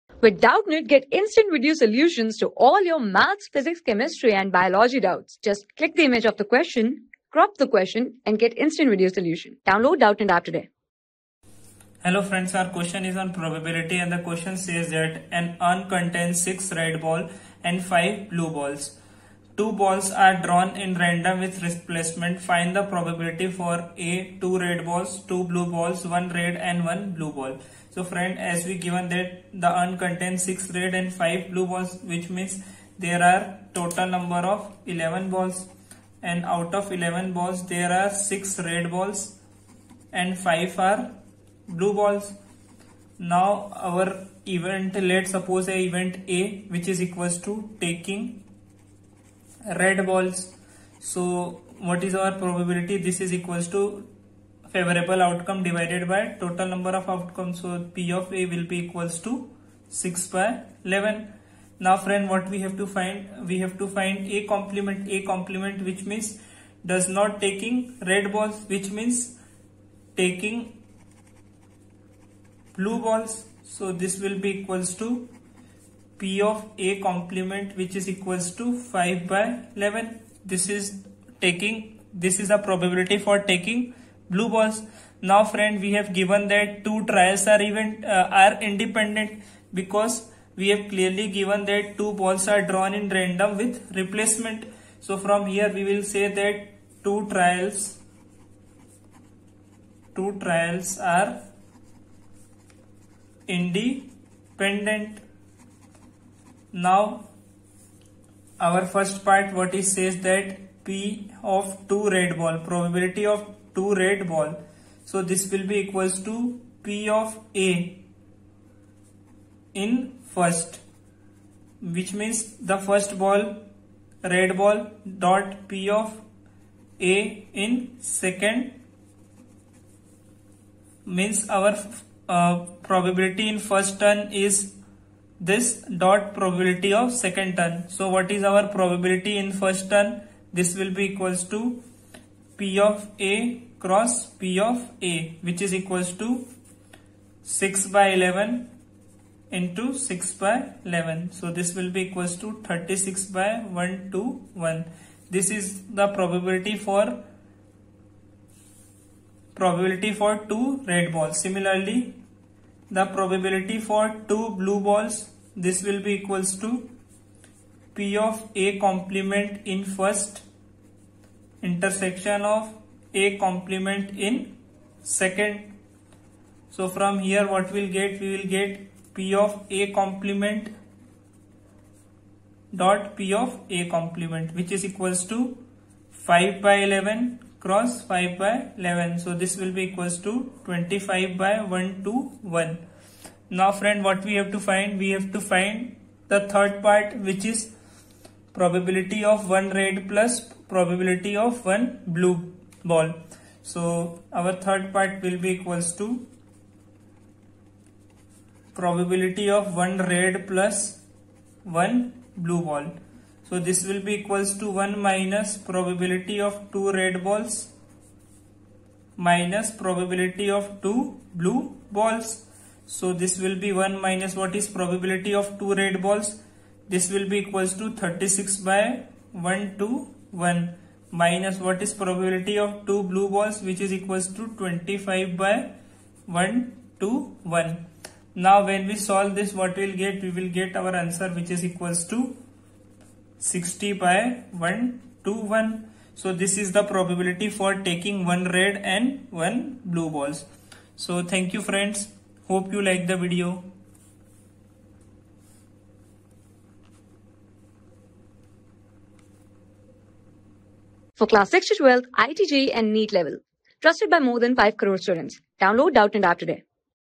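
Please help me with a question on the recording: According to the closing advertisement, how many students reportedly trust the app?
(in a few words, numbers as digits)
more than 5 crore.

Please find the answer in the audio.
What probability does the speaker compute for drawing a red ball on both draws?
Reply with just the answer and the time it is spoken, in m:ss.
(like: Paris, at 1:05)
36/121, at 2:32.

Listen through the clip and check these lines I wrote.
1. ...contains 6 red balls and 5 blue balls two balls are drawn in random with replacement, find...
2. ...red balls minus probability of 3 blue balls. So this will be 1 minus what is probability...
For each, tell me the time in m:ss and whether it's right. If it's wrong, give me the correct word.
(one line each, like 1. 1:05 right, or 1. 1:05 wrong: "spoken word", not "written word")
1. 0:15 right
2. 3:36 wrong: "2", not "3".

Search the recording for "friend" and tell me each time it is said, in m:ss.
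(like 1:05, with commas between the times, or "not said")
0:12, 0:28, 1:01, 1:25, 3:13, 4:11.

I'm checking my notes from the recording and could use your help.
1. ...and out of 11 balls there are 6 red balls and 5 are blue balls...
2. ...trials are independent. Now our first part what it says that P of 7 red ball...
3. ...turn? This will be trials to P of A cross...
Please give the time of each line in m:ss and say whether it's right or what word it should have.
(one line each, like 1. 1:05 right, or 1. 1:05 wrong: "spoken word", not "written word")
1. 0:36 right
2. 1:40 wrong: "2", not "7"
3. 2:19 wrong: "equals", not "trials".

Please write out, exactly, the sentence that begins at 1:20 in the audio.
This is taking, this is the probability for taking blue balls.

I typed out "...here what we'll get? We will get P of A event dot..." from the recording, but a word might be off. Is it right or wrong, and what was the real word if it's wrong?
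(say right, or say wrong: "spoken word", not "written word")
wrong: "complement", not "event".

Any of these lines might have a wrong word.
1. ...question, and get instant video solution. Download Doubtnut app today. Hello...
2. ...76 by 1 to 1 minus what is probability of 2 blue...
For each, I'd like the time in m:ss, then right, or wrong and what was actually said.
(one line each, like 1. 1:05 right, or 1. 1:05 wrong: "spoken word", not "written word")
1. 0:07 right
2. 3:47 wrong: "36", not "76".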